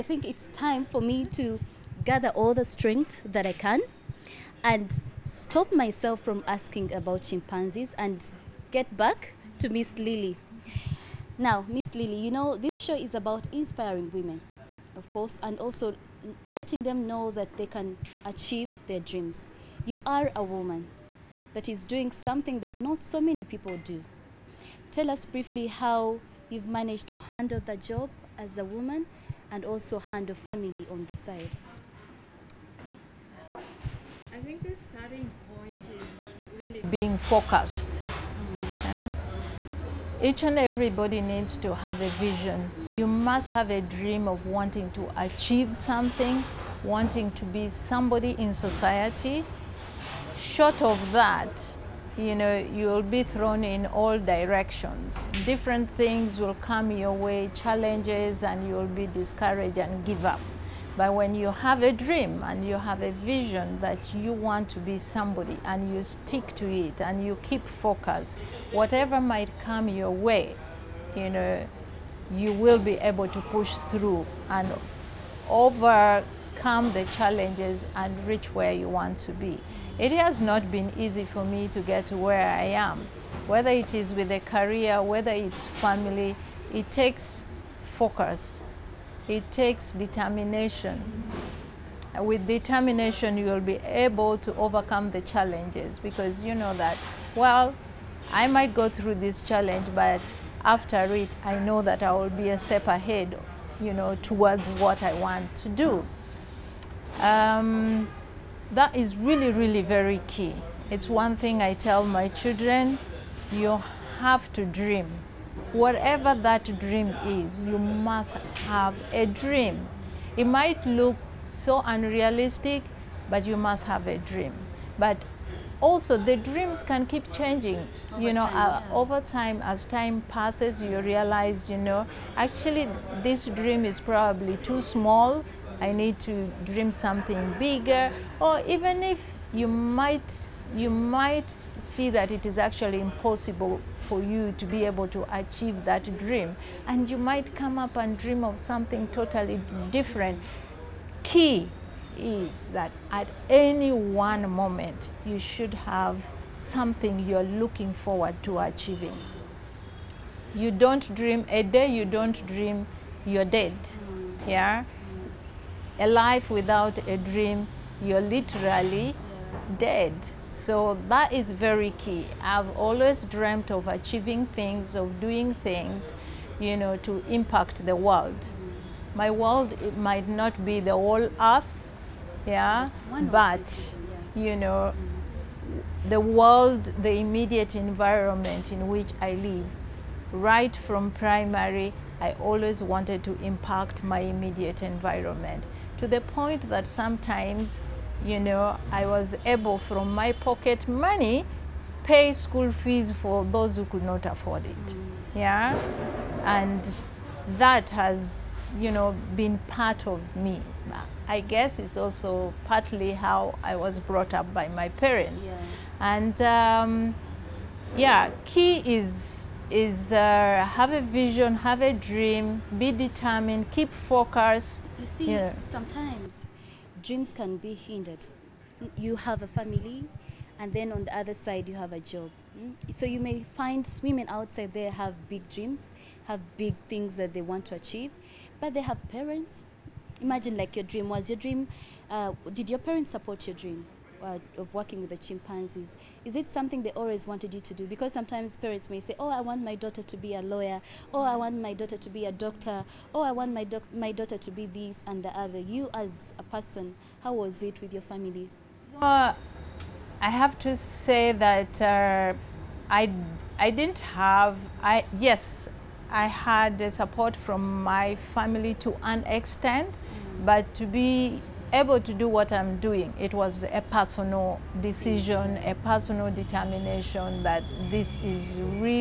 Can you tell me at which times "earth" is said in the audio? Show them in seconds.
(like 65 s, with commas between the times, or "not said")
181 s.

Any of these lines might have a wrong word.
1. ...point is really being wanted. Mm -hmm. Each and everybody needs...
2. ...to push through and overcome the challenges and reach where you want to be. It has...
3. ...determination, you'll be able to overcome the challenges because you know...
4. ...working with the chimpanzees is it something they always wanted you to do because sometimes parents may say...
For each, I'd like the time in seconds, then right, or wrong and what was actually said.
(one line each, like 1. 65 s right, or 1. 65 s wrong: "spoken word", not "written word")
1. 35 s wrong: "focused", not "wanted"
2. 73 s right
3. 92 s right
4. 244 s right.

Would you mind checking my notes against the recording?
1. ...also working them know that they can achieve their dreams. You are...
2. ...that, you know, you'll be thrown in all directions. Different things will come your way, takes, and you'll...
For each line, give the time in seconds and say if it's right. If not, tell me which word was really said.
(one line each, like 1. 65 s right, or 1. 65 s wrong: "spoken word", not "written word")
1. 15 s wrong: "letting", not "working"
2. 51 s wrong: "challenges", not "takes".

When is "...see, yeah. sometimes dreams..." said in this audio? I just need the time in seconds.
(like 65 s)
225 s.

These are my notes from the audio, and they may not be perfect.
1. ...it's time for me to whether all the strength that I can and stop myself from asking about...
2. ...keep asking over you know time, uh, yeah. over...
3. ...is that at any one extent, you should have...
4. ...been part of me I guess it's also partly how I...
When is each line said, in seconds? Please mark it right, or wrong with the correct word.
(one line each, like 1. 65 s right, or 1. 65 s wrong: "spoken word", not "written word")
1. 0 s wrong: "gather", not "whether"
2. 127 s wrong: "changing", not "asking"
3. 152 s wrong: "moment", not "extent"
4. 209 s right.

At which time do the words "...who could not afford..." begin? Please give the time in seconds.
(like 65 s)
203 s.